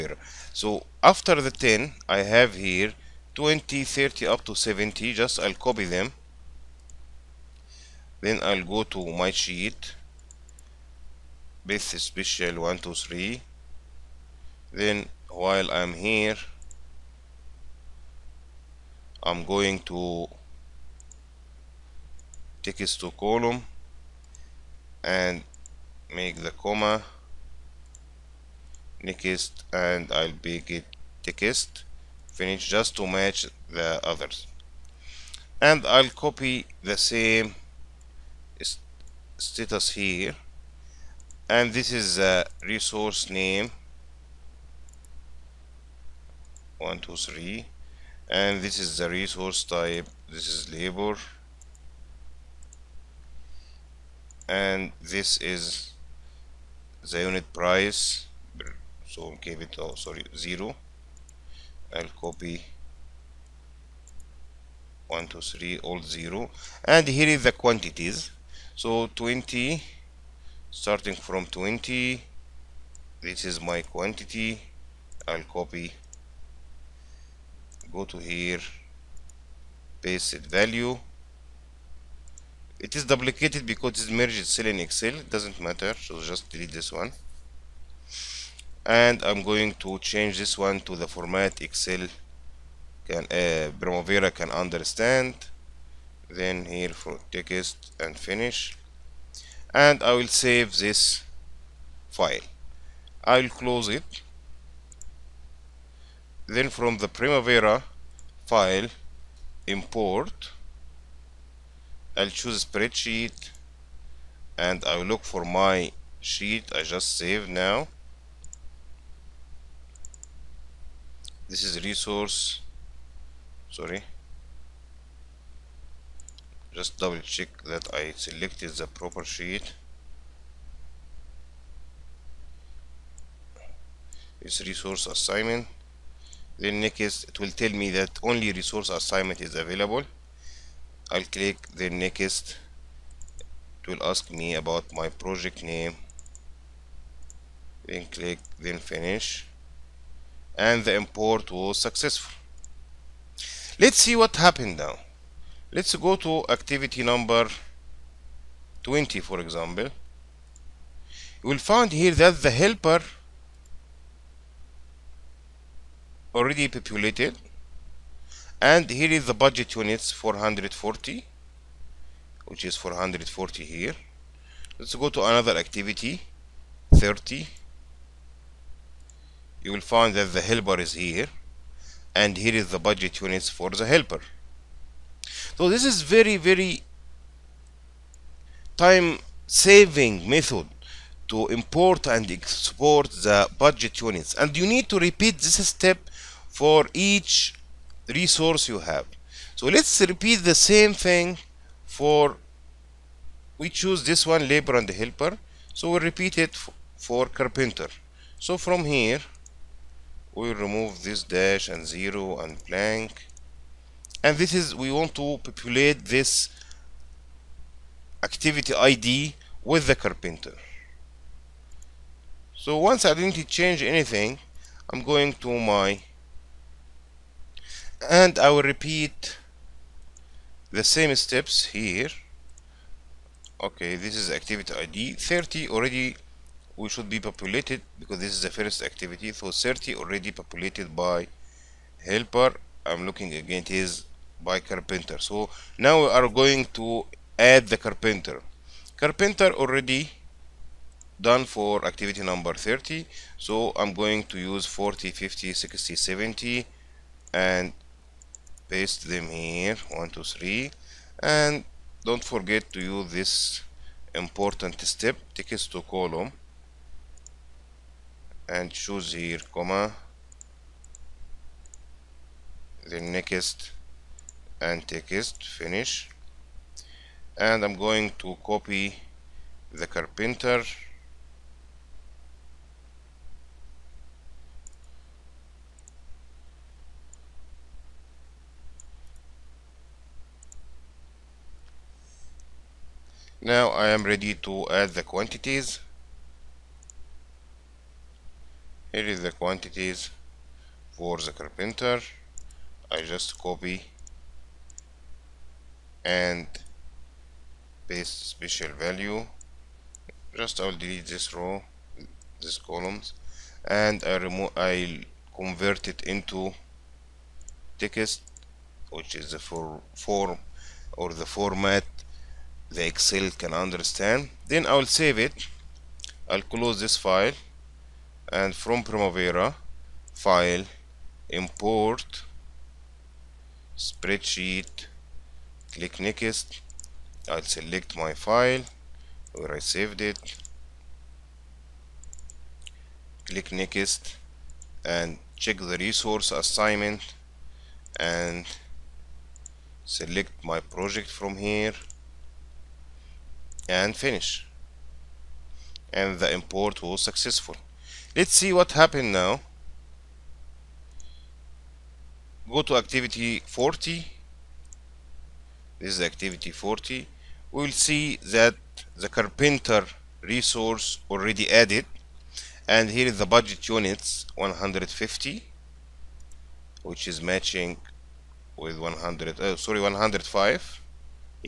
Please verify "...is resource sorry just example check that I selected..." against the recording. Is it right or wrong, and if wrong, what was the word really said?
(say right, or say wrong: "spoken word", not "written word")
wrong: "double", not "example".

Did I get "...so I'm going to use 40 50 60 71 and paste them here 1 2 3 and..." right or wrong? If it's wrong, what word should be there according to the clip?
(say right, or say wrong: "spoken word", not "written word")
wrong: "70", not "71".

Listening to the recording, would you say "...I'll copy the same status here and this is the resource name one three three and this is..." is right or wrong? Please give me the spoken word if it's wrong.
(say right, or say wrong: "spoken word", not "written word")
wrong: "two", not "three".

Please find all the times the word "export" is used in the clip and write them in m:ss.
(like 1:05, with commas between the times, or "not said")
3:12.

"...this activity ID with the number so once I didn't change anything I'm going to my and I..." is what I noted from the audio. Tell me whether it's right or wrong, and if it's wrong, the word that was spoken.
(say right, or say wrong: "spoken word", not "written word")
wrong: "carpenter", not "number".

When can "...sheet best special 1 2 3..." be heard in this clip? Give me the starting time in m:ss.
0:09.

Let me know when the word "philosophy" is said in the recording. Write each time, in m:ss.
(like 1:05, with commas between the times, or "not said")
not said.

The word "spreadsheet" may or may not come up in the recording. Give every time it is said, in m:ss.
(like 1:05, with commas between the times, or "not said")
1:52, 5:33.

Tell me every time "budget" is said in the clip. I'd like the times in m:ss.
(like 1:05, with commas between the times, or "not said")
2:49, 3:02, 3:13, 6:13.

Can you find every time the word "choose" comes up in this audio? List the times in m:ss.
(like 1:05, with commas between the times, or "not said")
1:52, 3:23, 4:28.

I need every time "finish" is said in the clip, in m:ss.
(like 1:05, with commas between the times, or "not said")
0:32, 1:38, 2:28, 4:35, 5:53.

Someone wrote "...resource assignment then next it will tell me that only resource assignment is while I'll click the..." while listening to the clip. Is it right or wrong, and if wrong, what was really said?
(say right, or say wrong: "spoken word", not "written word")
wrong: "available", not "while".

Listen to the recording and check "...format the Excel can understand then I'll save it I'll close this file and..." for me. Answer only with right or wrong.
right.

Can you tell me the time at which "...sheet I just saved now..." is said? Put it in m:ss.
1:56.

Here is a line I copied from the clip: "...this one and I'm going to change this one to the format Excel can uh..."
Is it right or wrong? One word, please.
right.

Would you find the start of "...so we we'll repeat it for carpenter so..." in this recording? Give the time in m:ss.
3:25.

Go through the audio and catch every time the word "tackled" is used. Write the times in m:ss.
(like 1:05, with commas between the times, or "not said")
not said.